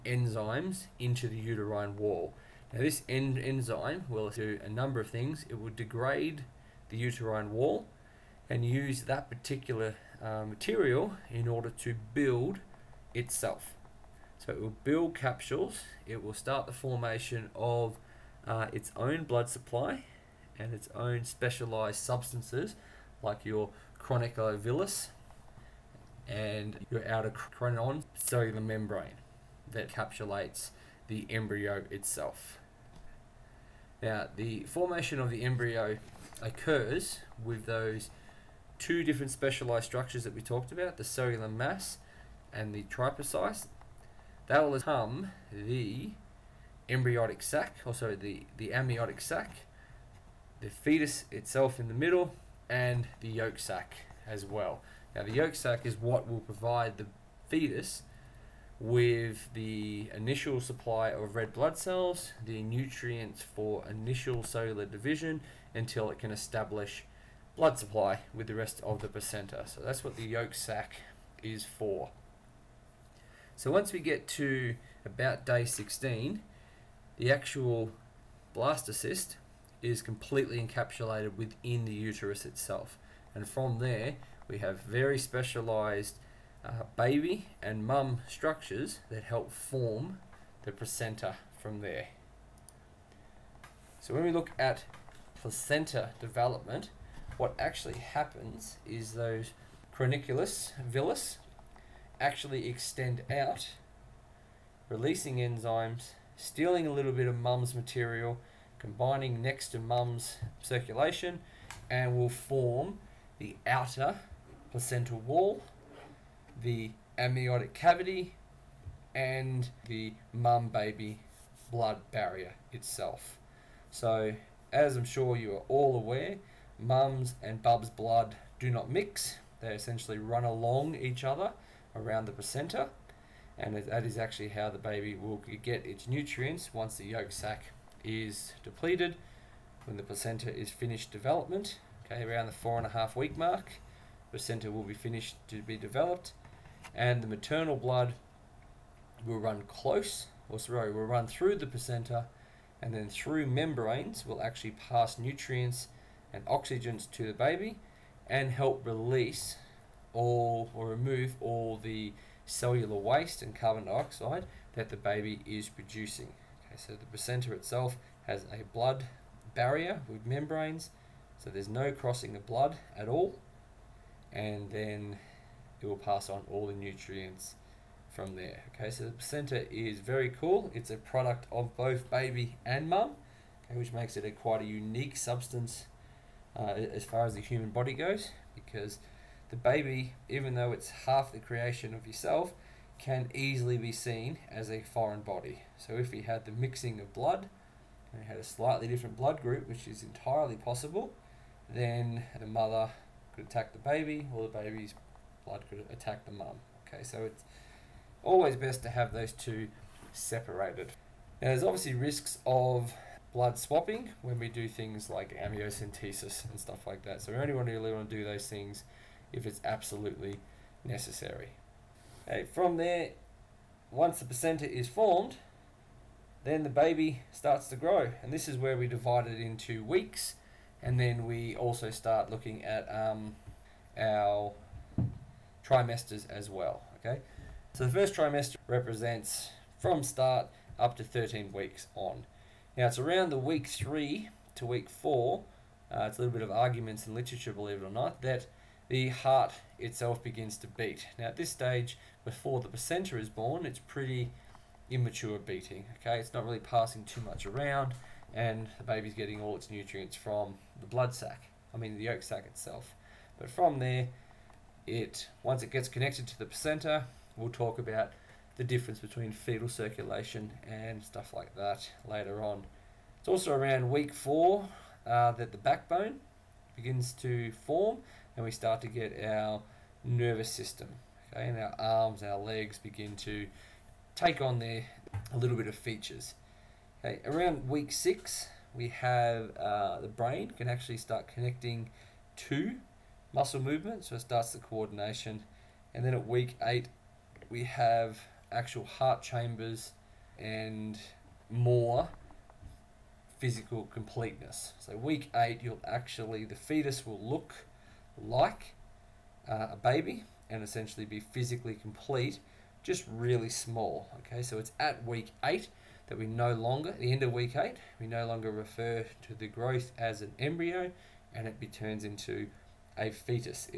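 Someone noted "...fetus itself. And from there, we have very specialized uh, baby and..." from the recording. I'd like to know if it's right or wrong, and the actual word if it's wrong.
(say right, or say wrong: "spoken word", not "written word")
wrong: "uterus", not "fetus".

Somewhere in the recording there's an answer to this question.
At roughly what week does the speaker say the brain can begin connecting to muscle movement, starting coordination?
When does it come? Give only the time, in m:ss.
4:47.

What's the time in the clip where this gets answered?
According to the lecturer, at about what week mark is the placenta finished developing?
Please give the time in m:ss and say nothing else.
2:22.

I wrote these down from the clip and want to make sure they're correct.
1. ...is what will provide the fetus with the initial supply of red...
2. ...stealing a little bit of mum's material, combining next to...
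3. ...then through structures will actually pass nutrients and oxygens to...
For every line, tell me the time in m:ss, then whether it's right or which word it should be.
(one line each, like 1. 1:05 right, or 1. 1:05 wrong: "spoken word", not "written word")
1. 0:55 right
2. 1:46 right
3. 2:32 wrong: "membranes", not "structures".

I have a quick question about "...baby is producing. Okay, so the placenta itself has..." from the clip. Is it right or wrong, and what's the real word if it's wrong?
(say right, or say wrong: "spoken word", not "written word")
right.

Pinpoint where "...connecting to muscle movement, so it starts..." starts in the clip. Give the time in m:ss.
4:51.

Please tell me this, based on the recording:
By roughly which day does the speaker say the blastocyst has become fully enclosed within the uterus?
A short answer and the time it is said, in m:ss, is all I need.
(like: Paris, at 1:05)
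day 16, at 1:15.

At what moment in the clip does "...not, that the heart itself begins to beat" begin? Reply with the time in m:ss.
4:07.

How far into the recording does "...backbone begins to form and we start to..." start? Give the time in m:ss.
4:35.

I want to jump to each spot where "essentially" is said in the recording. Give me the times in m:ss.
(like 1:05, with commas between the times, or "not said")
2:09, 5:10.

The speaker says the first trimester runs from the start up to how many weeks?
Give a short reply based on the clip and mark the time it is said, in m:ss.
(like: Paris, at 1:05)
13, at 4:01.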